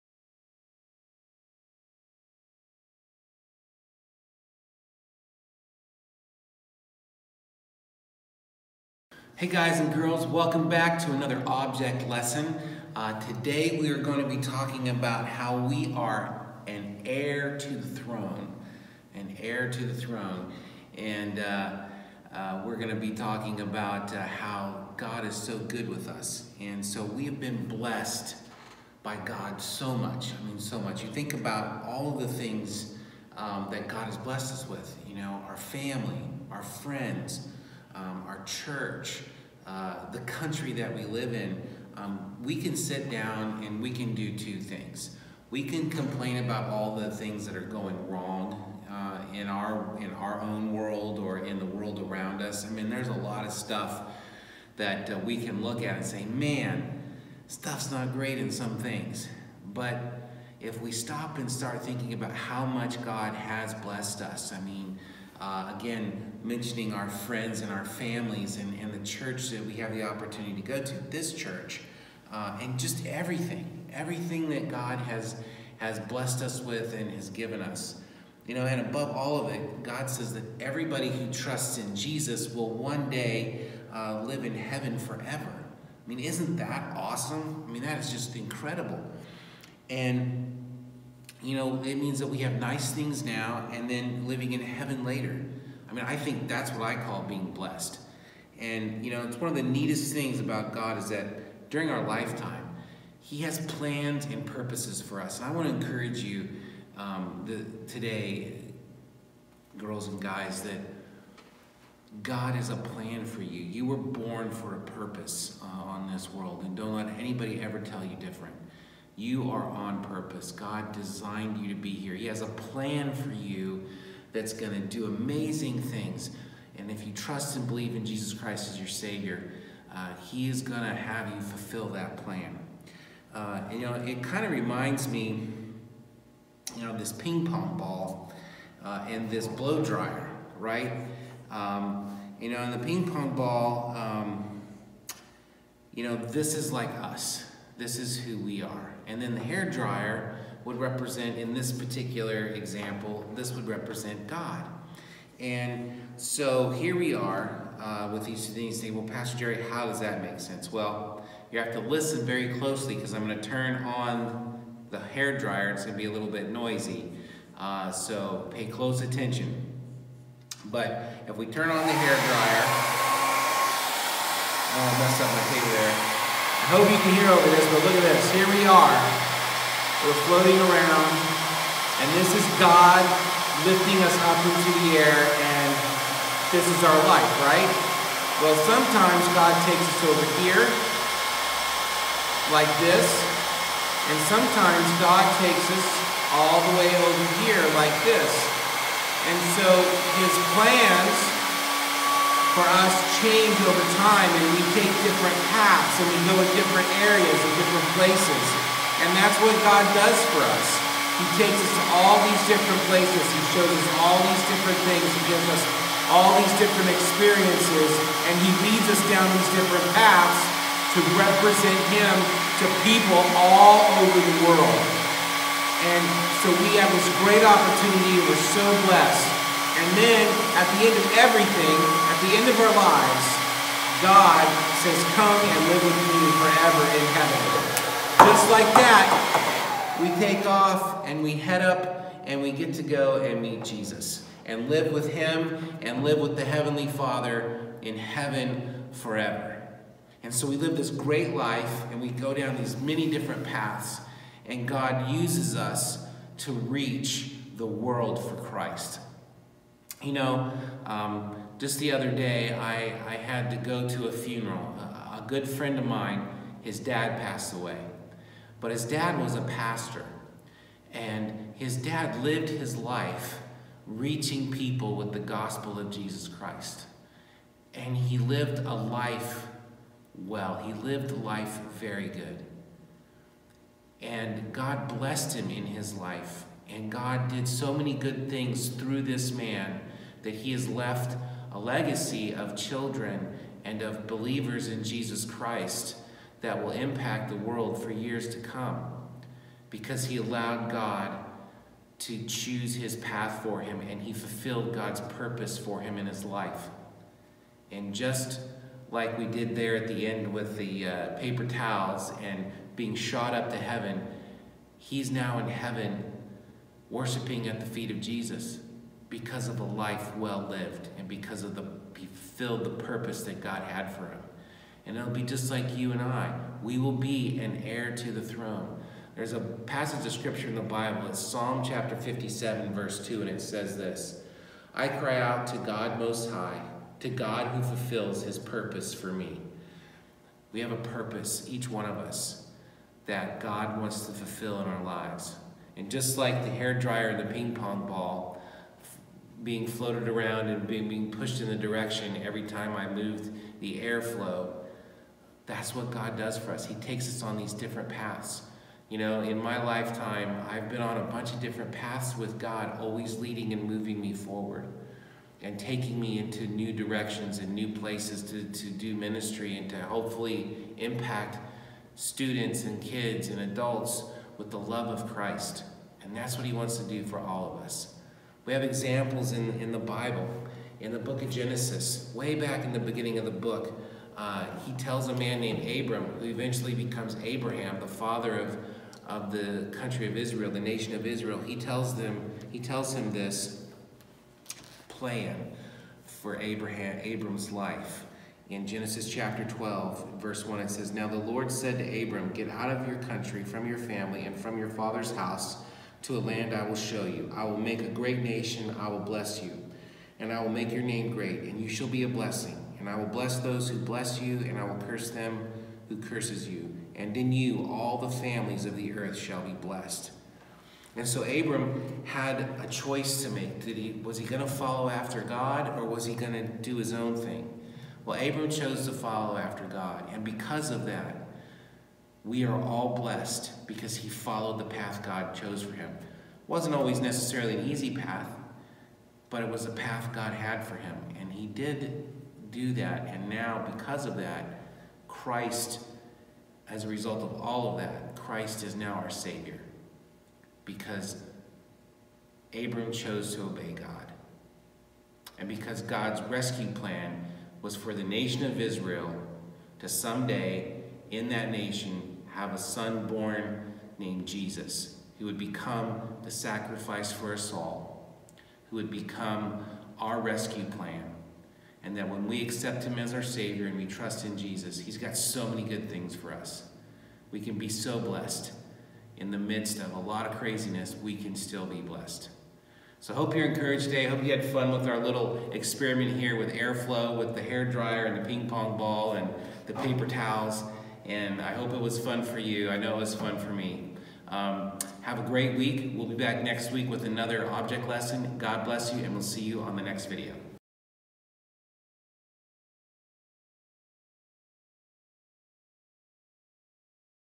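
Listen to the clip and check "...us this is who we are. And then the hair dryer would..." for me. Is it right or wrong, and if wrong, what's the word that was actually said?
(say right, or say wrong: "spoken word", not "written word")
right.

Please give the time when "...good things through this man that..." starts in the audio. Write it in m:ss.
4:47.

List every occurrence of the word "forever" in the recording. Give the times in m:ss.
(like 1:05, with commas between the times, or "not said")
1:24, 3:56, 4:08.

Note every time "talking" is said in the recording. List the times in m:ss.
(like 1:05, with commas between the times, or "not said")
0:14, 0:23.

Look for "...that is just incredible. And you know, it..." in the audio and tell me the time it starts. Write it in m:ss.
1:27.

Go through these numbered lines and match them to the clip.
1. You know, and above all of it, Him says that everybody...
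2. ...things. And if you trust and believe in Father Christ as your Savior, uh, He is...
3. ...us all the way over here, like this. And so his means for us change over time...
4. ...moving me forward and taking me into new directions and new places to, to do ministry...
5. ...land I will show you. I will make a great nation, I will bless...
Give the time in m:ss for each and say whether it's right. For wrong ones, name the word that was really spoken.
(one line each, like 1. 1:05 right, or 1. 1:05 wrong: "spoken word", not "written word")
1. 1:18 wrong: "God", not "Him"
2. 2:05 wrong: "Jesus", not "Father"
3. 3:15 wrong: "plans", not "means"
4. 6:03 right
5. 6:46 right.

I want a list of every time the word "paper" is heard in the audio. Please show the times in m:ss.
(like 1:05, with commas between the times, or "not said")
2:55, 5:11, 8:09.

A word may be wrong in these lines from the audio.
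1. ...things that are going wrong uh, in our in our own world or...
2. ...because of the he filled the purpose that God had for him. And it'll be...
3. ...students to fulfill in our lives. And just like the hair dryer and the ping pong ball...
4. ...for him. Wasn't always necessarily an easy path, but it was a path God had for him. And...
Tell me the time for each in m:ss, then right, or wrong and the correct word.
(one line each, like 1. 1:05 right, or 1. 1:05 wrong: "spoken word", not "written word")
1. 0:47 right
2. 5:21 right
3. 5:43 wrong: "wants", not "students"
4. 7:15 right.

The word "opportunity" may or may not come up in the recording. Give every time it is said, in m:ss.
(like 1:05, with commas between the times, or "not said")
1:10, 3:47.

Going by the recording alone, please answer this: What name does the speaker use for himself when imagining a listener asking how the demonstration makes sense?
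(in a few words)
Pastor Jerry.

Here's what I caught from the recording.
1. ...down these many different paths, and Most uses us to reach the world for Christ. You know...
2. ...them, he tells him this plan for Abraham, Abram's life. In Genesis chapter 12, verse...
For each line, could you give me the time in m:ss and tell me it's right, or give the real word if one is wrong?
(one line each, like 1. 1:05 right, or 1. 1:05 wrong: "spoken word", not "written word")
1. 4:12 wrong: "God", not "Most"
2. 6:31 right.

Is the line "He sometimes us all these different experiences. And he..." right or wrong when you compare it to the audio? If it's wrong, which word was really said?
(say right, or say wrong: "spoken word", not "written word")
wrong: "gives", not "sometimes".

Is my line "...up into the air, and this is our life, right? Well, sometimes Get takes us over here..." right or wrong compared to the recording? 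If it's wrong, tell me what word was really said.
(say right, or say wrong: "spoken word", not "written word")
wrong: "God", not "Get".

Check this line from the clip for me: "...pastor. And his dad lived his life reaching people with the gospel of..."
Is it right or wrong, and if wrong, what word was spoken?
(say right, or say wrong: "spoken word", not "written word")
right.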